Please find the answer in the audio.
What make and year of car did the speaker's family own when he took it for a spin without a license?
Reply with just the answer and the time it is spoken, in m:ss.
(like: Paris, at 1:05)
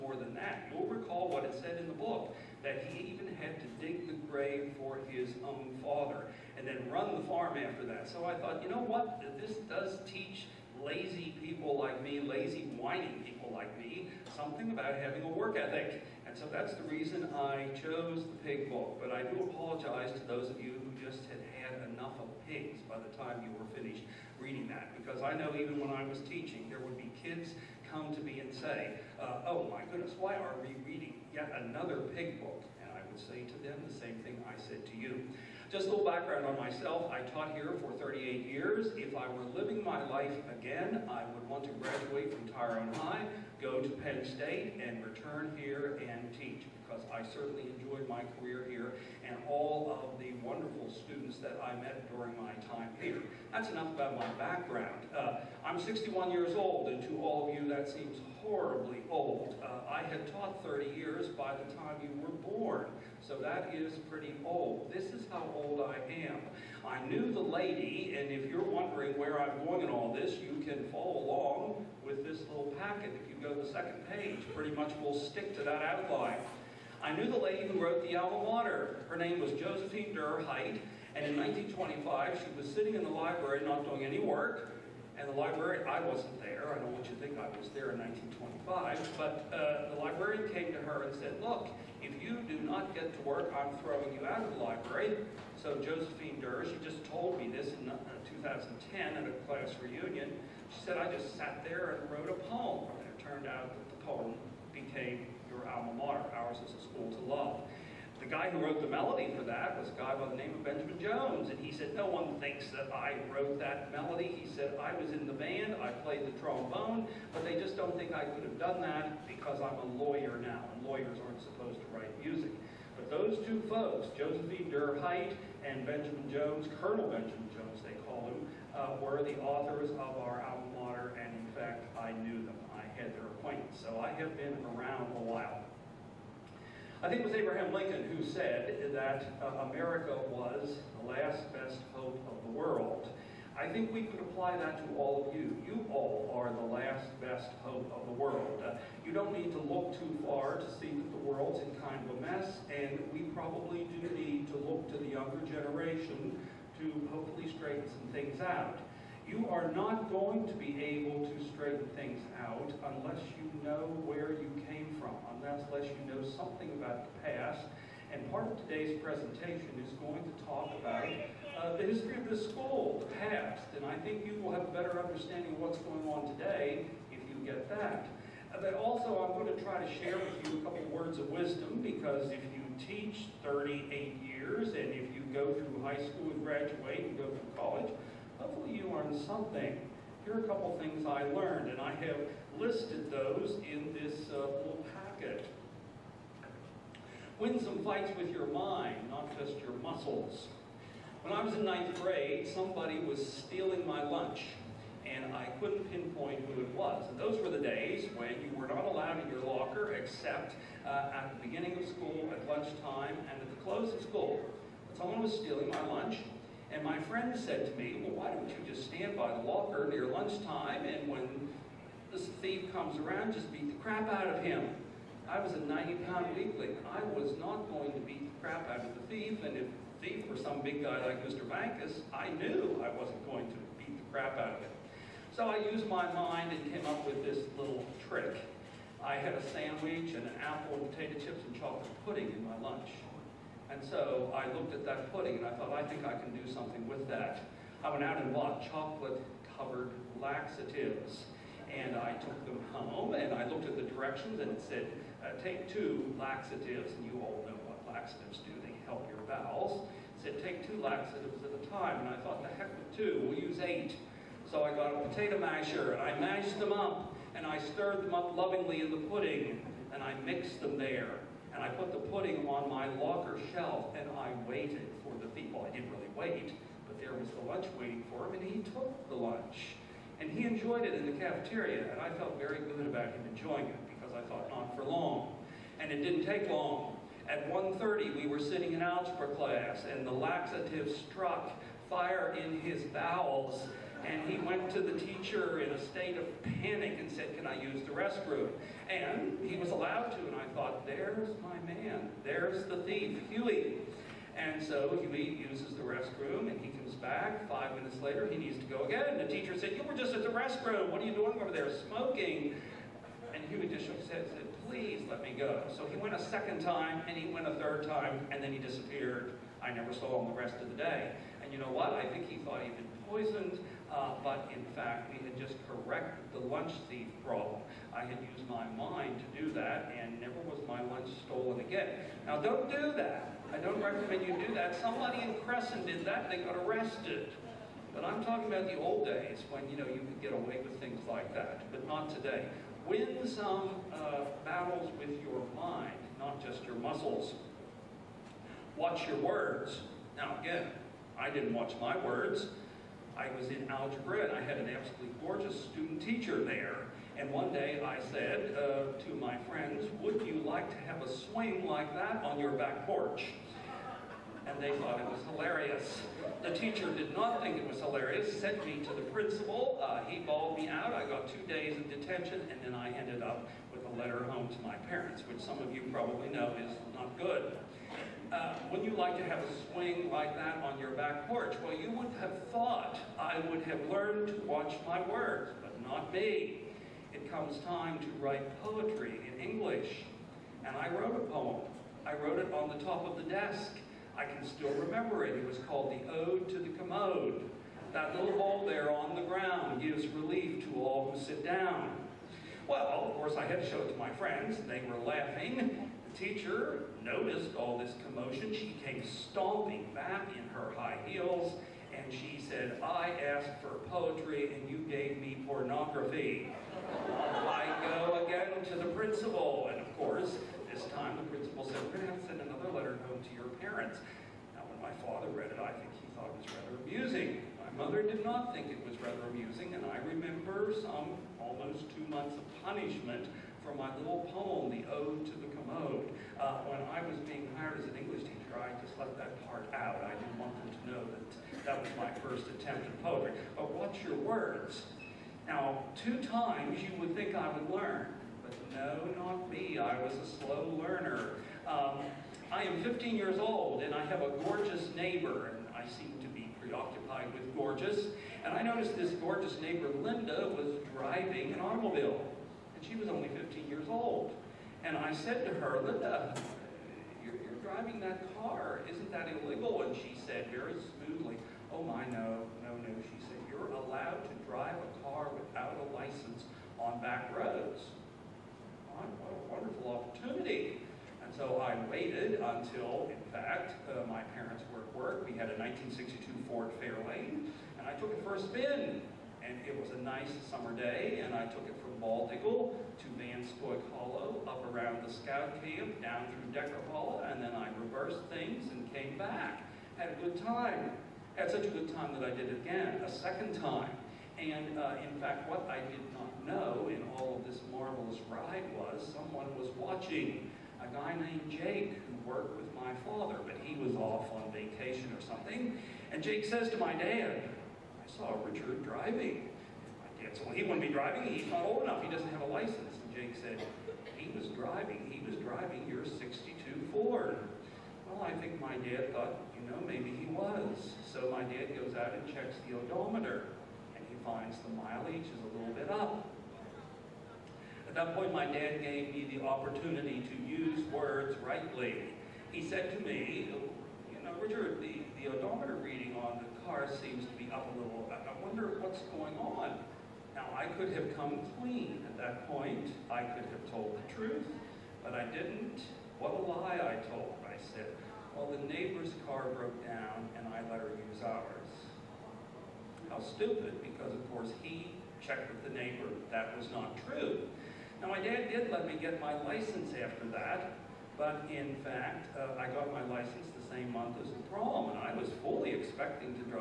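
1962 Ford Fairlane, at 8:05.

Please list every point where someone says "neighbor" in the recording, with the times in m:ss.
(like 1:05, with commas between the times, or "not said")
7:34, 7:39, 9:18, 9:25.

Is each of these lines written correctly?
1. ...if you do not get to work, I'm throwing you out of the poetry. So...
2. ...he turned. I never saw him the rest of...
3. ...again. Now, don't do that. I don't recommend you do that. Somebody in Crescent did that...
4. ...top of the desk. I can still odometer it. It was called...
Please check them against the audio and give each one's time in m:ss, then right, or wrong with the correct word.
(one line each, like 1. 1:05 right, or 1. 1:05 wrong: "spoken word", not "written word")
1. 1:32 wrong: "library", not "poetry"
2. 5:18 wrong: "disappeared", not "turned"
3. 5:31 right
4. 6:32 wrong: "remember", not "odometer".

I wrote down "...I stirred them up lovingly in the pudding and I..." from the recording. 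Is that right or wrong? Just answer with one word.
right.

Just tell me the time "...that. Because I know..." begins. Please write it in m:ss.
0:24.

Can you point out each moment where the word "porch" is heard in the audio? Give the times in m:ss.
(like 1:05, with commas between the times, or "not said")
6:02, 6:21.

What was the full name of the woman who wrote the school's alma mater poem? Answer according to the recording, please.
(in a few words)
Josephine Durr Haidt.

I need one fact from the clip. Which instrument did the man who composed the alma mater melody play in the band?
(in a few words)
Trombone.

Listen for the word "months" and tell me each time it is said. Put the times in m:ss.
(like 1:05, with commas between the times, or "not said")
7:12, 9:33.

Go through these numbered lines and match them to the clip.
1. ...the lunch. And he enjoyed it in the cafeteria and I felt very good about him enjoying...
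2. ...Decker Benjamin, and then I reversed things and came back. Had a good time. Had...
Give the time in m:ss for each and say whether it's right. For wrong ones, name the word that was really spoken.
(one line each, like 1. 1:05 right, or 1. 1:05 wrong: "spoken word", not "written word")
1. 4:39 right
2. 8:16 wrong: "Hollow", not "Benjamin".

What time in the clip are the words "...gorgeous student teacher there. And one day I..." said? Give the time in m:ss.
5:55.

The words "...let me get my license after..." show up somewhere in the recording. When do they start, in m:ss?
9:28.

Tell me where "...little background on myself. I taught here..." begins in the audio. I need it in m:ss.
0:35.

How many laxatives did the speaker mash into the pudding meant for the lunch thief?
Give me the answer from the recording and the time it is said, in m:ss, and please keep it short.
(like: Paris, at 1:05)
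8, at 4:23.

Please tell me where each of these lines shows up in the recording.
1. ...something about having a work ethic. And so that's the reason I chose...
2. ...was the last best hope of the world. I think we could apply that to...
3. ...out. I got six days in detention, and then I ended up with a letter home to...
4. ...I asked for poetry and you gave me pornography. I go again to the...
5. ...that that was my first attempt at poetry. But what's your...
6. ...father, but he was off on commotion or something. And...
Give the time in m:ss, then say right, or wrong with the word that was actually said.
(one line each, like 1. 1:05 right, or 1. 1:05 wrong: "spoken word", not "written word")
1. 0:14 right
2. 2:20 right
3. 6:10 wrong: "two", not "six"
4. 6:52 right
5. 7:21 right
6. 8:32 wrong: "vacation", not "commotion".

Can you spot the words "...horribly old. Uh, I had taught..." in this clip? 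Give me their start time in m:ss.
0:58.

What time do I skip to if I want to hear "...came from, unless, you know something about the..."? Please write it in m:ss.
2:44.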